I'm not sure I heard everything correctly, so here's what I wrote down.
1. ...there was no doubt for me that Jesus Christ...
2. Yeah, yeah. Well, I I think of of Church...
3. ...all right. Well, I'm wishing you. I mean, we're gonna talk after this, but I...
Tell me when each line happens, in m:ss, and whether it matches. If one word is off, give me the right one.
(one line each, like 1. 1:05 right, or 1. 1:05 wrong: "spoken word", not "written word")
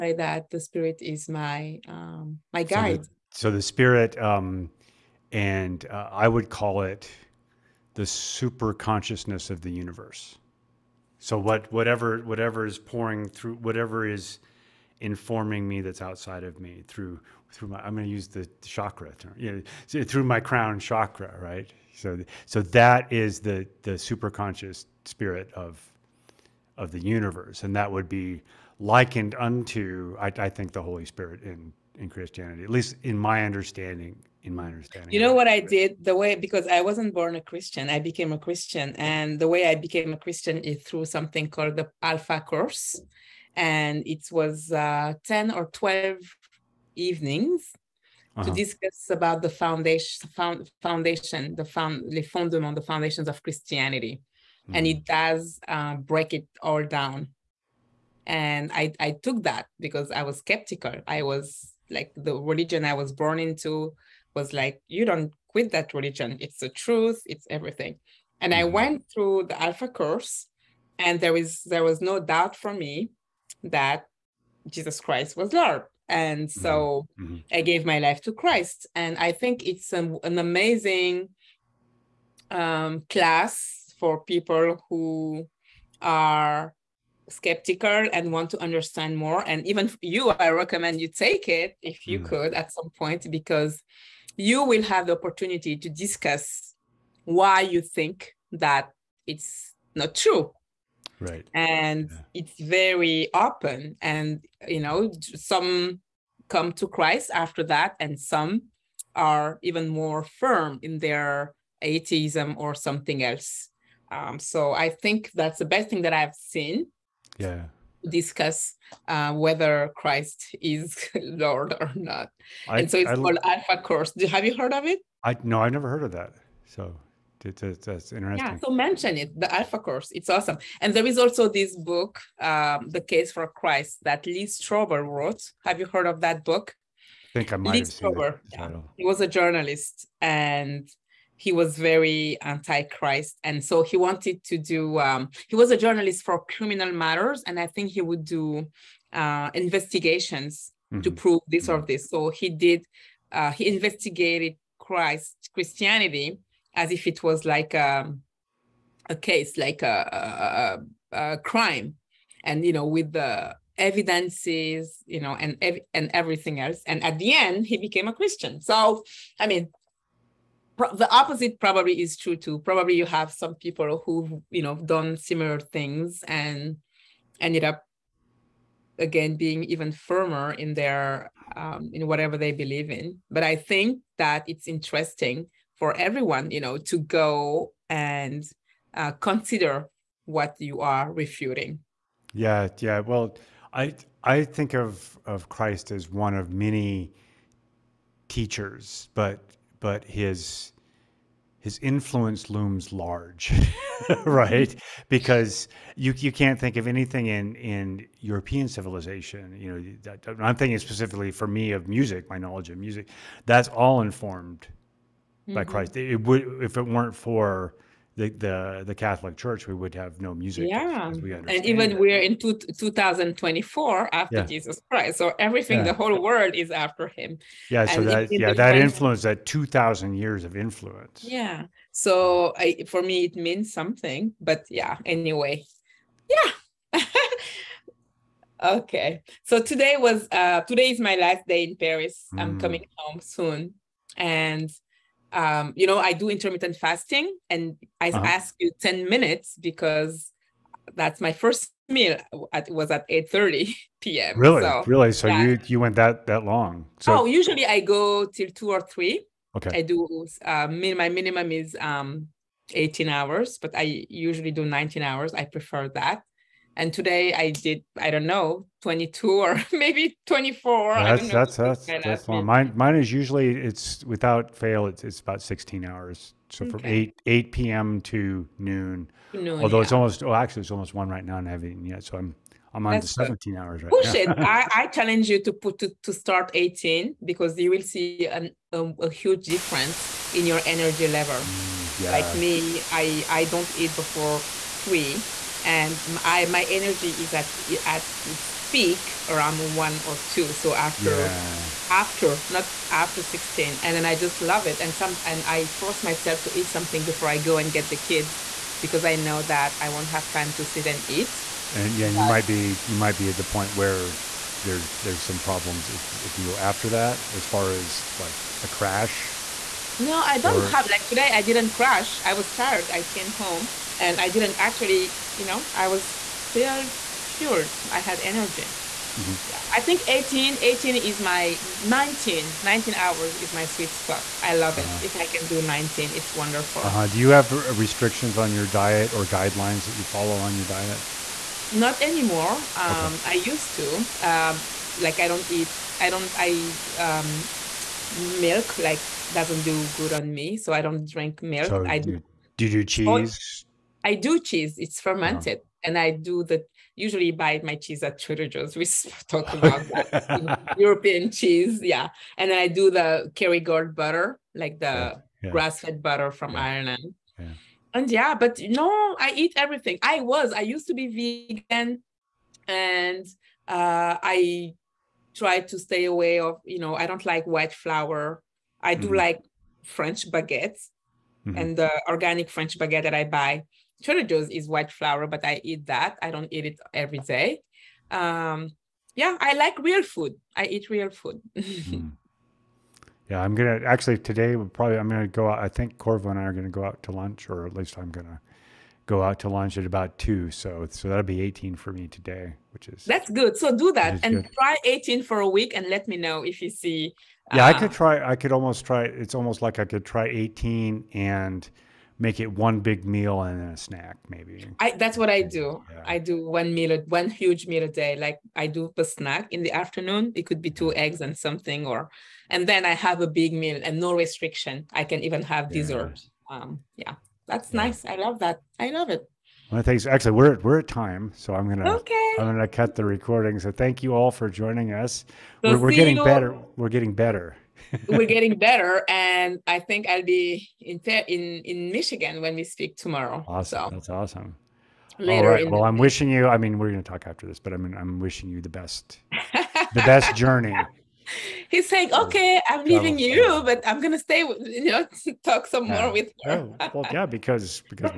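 1. 1:11 right
2. 3:12 wrong: "Christ", not "Church"
3. 7:25 right.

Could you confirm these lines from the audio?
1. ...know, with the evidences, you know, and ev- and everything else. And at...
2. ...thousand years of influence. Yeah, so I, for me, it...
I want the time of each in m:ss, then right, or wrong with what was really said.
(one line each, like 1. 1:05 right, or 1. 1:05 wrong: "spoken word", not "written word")
1. 2:42 right
2. 3:49 right.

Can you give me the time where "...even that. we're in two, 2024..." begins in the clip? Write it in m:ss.
3:41.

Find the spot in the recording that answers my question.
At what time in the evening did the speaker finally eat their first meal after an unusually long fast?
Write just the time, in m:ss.
4:13.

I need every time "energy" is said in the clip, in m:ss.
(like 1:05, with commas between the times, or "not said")
4:50, 4:56, 5:28.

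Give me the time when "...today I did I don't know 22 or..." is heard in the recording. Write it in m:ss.
4:26.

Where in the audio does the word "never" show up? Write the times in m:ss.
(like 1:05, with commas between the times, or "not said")
2:05.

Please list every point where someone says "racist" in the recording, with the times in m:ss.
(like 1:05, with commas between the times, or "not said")
not said.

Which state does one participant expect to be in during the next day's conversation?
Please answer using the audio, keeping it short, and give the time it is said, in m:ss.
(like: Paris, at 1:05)
Michigan, at 7:21.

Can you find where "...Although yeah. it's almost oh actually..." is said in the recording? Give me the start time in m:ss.
4:39.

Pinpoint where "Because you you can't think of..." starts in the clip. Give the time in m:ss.
3:25.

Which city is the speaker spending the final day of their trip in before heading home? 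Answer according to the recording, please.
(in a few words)
Paris.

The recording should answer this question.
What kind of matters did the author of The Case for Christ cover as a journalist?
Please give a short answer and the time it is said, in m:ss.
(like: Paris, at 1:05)
criminal matters, at 2:26.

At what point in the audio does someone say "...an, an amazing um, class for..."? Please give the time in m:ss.
1:19.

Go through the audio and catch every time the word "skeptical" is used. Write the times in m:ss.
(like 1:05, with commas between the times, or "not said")
1:00, 1:27.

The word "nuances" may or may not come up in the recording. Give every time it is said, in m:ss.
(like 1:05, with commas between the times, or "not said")
not said.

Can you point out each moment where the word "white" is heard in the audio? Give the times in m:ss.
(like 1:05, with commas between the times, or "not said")
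6:17, 6:24.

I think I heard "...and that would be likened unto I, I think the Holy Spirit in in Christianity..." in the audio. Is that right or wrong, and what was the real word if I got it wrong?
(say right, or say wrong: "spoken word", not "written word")
right.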